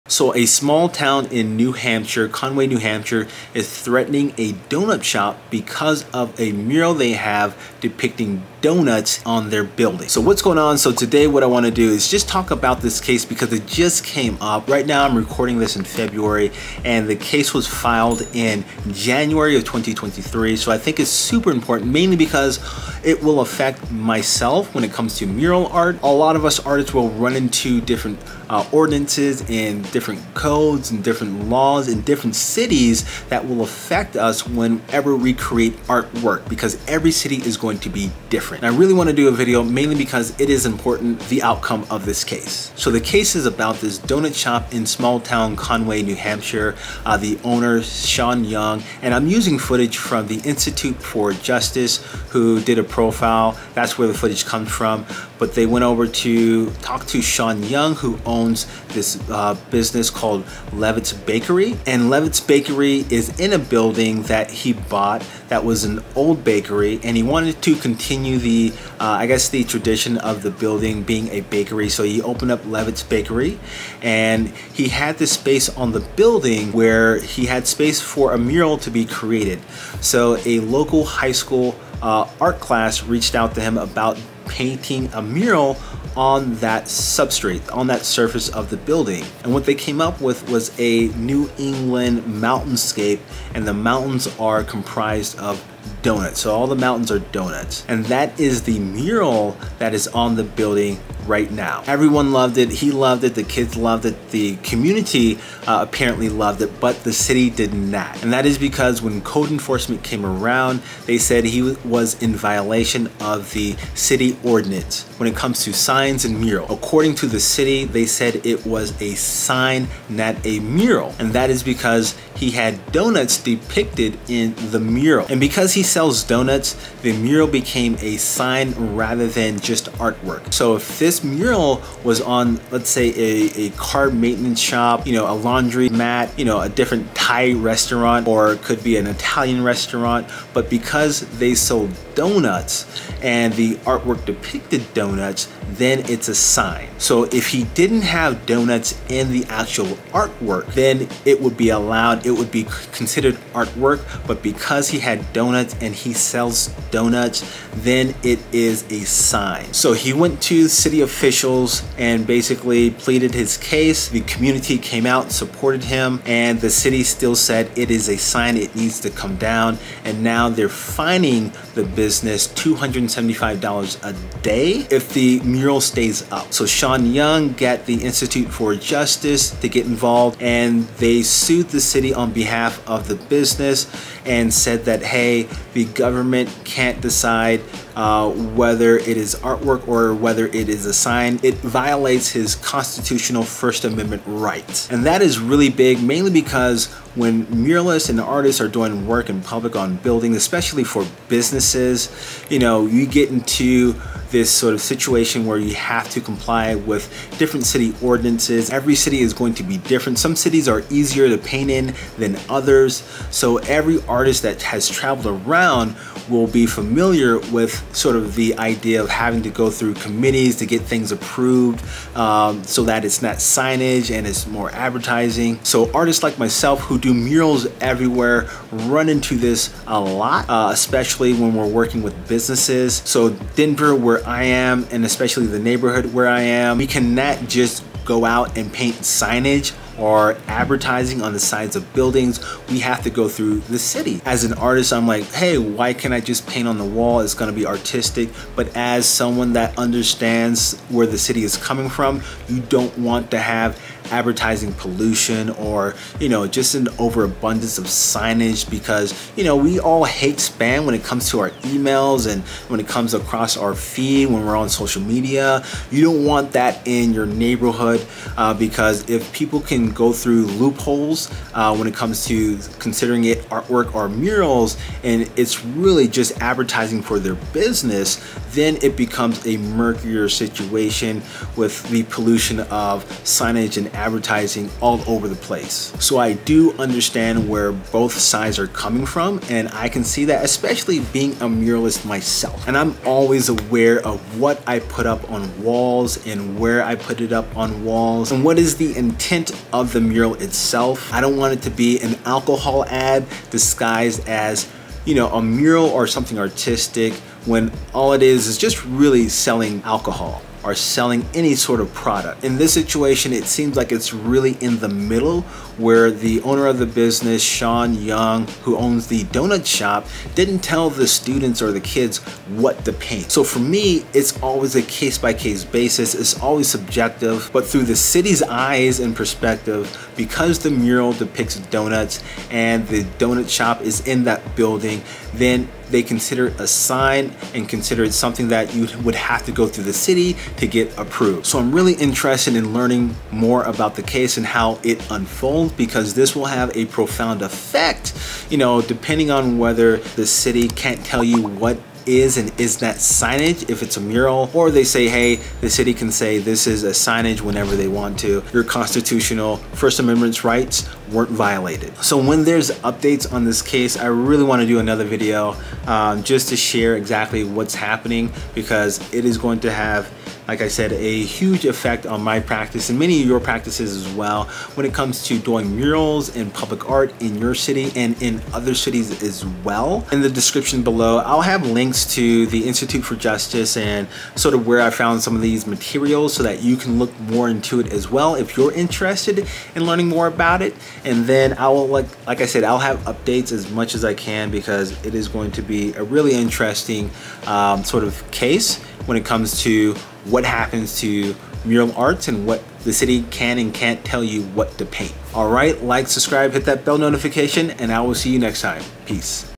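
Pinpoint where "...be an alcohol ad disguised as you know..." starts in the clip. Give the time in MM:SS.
05:01.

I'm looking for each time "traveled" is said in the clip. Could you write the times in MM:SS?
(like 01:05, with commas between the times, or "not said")
03:34.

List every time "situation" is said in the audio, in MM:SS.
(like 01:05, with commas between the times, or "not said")
03:24, 04:40, 05:12.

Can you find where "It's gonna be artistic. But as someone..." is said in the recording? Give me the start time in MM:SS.
04:07.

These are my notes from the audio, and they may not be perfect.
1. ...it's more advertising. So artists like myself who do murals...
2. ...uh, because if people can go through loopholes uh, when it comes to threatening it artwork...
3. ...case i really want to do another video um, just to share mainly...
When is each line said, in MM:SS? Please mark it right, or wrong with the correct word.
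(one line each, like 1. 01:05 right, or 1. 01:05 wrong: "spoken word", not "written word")
1. 03:44 right
2. 04:28 wrong: "considering", not "threatening"
3. 06:03 wrong: "exactly", not "mainly".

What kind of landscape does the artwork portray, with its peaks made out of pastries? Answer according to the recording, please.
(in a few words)
New England mountainscape.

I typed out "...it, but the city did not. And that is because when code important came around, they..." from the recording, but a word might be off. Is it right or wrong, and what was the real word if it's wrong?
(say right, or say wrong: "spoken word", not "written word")
wrong: "enforcement", not "important".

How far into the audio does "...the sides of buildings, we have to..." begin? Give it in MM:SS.
04:01.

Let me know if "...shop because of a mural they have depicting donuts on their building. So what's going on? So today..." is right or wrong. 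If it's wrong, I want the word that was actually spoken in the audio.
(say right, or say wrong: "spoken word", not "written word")
right.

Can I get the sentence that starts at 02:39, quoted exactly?
So he went to city officials and basically pleaded his case.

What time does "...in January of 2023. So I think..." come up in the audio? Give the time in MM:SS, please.
00:18.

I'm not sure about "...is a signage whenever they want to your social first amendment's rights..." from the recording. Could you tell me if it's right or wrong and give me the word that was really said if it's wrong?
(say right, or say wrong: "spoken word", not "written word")
wrong: "constitutional", not "social".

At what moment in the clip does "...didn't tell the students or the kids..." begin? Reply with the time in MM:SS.
05:20.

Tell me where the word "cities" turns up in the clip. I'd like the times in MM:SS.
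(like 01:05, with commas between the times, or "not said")
00:32, 03:30, 06:18.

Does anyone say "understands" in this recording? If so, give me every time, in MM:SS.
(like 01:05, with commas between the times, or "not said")
04:09, 04:46.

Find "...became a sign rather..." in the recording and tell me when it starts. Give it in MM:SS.
02:07.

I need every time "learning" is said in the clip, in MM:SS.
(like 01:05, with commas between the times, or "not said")
05:42, 06:29.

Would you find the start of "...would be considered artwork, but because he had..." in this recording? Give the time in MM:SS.
02:32.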